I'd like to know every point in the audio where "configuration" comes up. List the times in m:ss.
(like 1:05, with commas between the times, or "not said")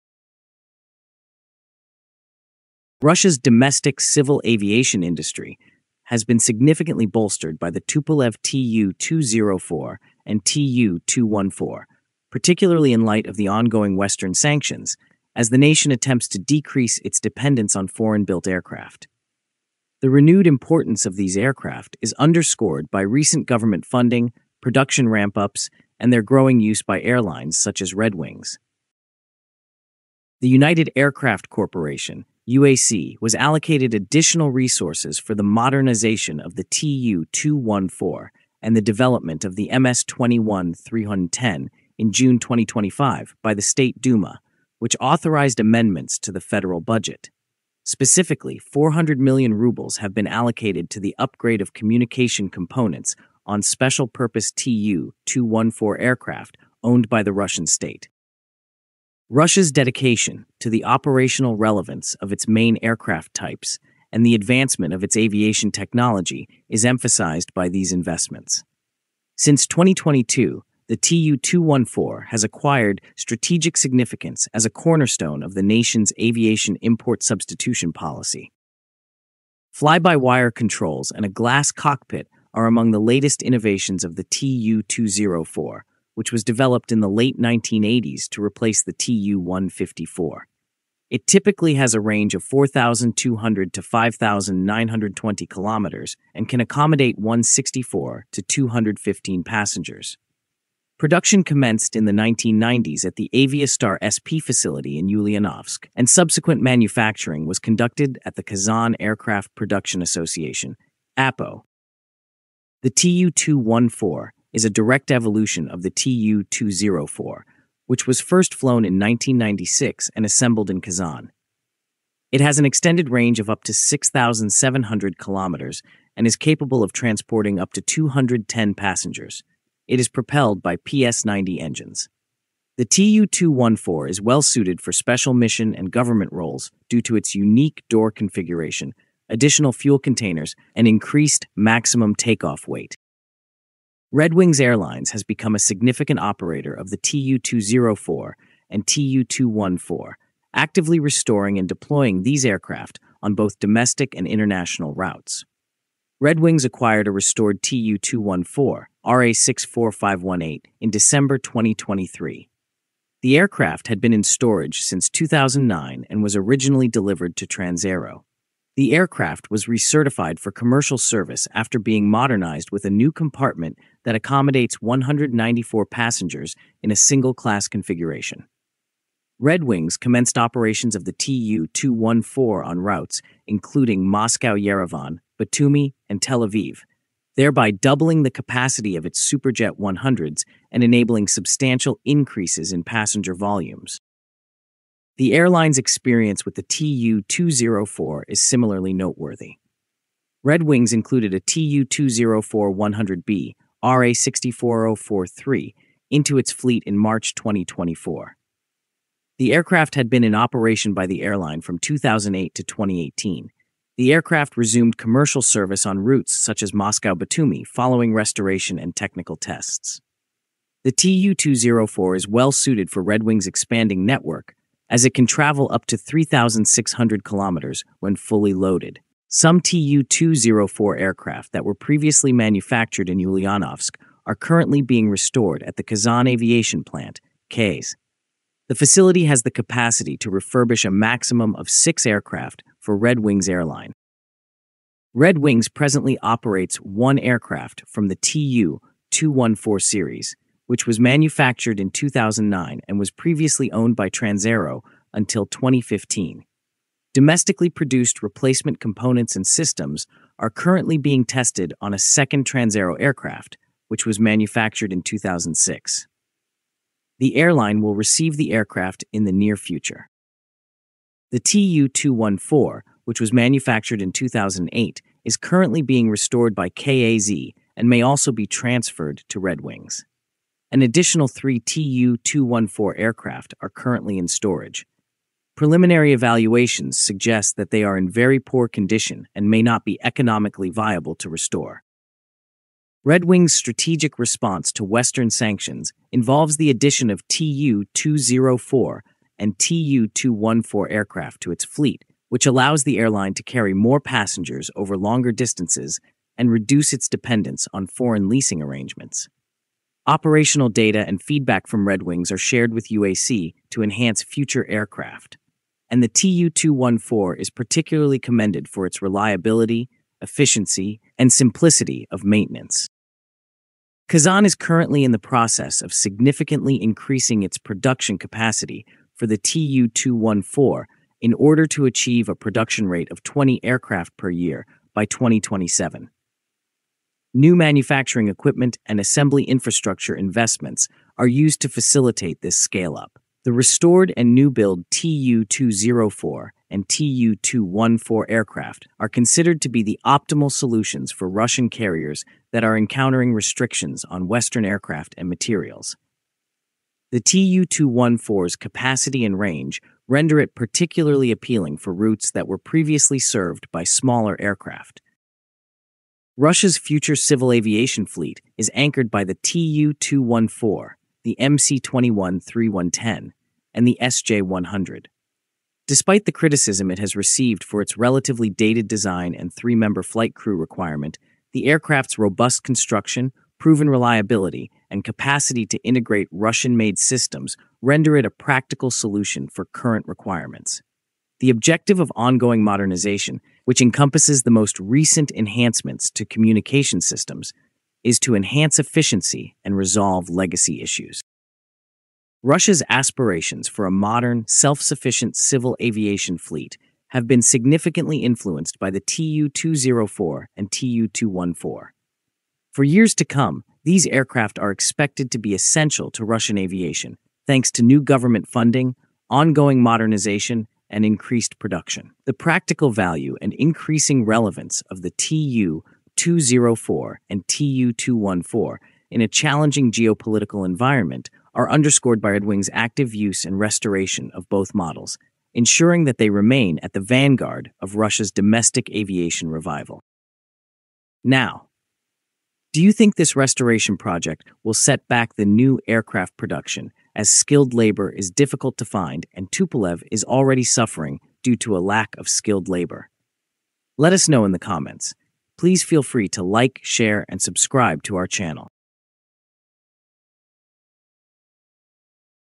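2:18, 2:57.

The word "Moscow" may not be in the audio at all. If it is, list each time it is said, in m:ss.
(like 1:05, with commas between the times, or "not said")
3:04, 3:36.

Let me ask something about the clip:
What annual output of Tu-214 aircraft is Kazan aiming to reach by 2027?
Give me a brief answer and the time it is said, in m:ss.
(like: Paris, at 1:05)
20 aircraft per year, at 5:33.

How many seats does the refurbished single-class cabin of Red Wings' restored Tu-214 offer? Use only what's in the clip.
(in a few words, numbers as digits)
194.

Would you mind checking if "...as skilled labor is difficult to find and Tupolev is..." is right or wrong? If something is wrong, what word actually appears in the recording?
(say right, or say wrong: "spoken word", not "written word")
right.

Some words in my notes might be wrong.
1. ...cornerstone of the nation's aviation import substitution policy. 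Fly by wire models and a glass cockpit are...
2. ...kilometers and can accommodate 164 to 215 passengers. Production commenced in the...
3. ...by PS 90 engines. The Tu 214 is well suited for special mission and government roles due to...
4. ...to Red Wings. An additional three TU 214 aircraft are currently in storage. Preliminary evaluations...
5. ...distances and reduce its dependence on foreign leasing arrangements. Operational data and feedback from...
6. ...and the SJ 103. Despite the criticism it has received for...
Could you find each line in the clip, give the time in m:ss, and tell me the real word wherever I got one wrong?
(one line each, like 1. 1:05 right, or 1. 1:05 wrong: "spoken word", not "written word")
1. 1:14 wrong: "controls", not "models"
2. 1:35 right
3. 2:10 right
4. 4:39 right
5. 5:05 right
6. 6:13 wrong: "100", not "103".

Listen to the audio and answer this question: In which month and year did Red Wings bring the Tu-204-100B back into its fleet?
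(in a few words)
March 2024.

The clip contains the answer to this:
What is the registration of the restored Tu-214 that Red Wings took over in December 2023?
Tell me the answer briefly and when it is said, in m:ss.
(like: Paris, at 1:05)
RA 64518, at 2:39.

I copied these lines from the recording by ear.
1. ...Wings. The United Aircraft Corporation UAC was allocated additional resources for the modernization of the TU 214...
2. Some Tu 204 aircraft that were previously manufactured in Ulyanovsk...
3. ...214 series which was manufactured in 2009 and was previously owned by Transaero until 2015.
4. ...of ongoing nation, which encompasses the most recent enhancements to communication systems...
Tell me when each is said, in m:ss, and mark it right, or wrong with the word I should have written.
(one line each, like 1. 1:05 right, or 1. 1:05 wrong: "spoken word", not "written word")
1. 0:28 right
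2. 3:49 right
3. 4:09 right
4. 6:31 wrong: "modernization", not "nation".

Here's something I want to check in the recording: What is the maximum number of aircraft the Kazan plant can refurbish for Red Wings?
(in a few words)
6.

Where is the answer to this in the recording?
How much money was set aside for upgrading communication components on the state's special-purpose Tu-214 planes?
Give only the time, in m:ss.
0:48.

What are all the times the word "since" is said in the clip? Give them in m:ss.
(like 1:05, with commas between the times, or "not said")
1:09, 2:44.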